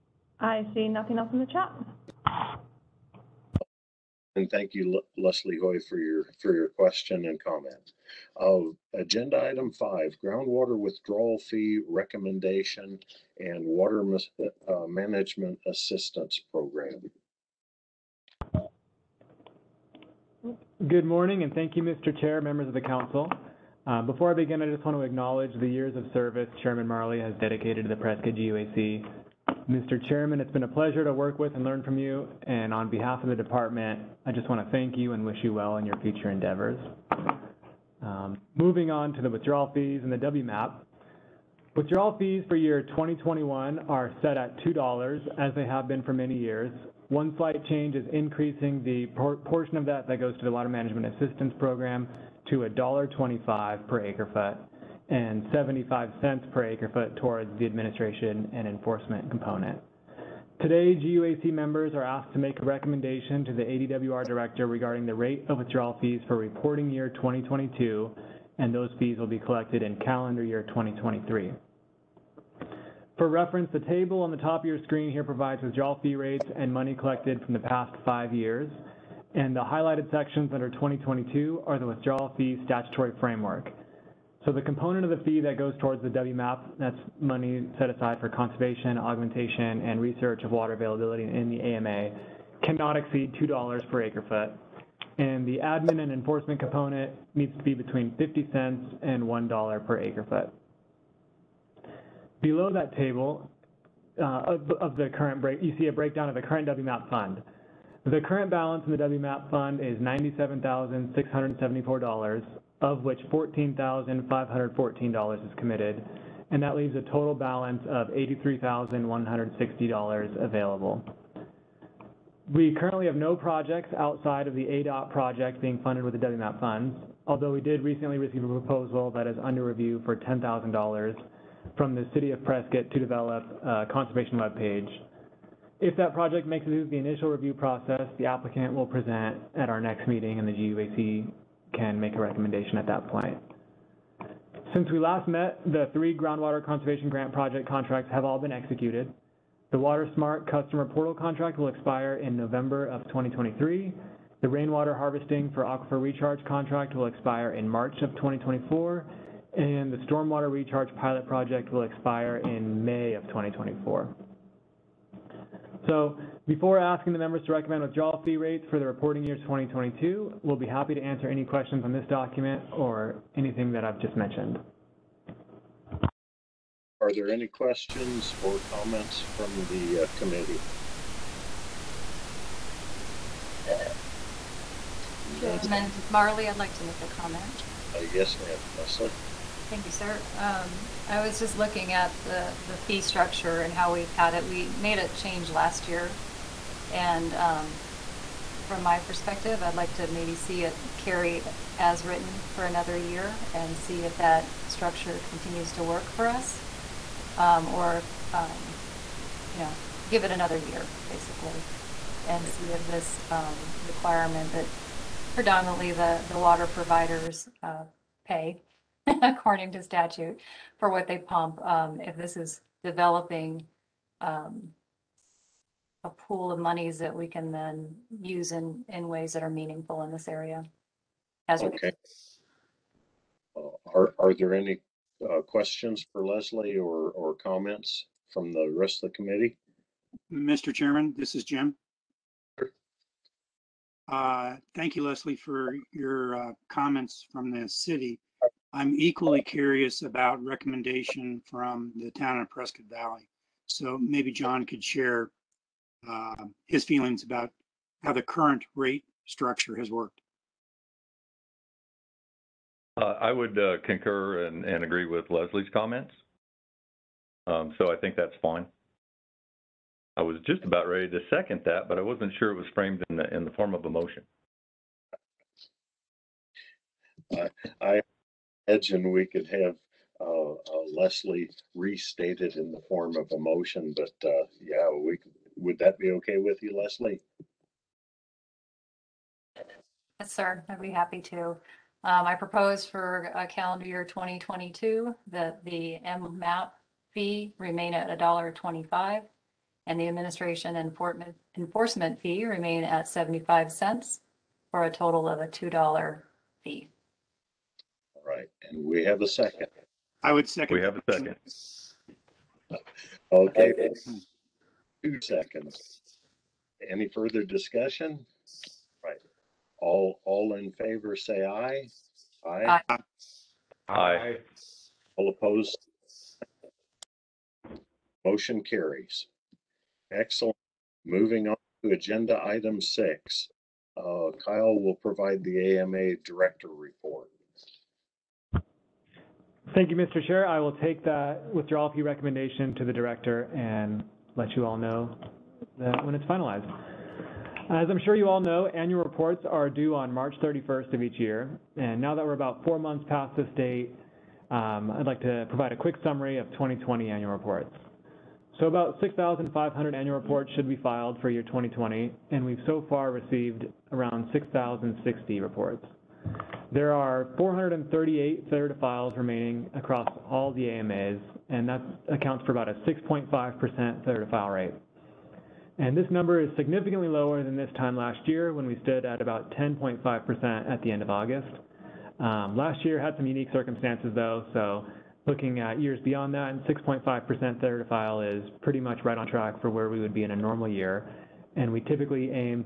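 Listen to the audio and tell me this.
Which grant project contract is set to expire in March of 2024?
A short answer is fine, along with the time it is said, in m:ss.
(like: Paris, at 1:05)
Rainwater harvesting for aquifer recharge, at 2:34.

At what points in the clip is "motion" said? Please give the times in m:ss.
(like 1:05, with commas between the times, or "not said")
4:33, 4:43, 5:28.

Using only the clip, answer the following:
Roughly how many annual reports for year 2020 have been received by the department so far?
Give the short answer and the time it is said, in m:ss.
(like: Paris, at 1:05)
6,060, at 6:04.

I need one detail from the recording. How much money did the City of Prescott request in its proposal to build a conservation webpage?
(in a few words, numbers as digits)
$10,000.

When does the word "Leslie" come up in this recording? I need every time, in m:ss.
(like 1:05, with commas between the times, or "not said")
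0:05, 3:08, 3:56, 4:05, 4:25, 4:40, 4:46.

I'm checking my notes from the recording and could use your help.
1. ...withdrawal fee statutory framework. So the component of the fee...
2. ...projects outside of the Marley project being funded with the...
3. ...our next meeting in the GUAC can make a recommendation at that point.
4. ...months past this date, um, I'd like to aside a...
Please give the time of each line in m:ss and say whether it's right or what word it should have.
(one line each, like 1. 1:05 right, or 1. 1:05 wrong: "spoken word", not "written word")
1. 1:21 right
2. 2:03 wrong: "ADOT", not "Marley"
3. 2:19 right
4. 5:52 wrong: "provide", not "aside".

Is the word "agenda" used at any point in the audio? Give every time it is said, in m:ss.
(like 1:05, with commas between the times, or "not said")
0:08, 5:31.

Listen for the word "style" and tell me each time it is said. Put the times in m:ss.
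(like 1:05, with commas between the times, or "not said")
not said.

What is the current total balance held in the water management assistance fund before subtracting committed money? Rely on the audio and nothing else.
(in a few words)
$97,674.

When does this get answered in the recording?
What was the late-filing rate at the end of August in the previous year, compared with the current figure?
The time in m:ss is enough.
6:19.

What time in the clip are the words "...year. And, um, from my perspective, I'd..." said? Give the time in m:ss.
3:15.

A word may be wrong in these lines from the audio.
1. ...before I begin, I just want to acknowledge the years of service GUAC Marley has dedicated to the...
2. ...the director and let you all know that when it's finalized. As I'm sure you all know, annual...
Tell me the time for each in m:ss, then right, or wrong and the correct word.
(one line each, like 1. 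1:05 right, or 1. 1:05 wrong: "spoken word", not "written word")
1. 0:24 wrong: "Chairman", not "GUAC"
2. 5:42 right.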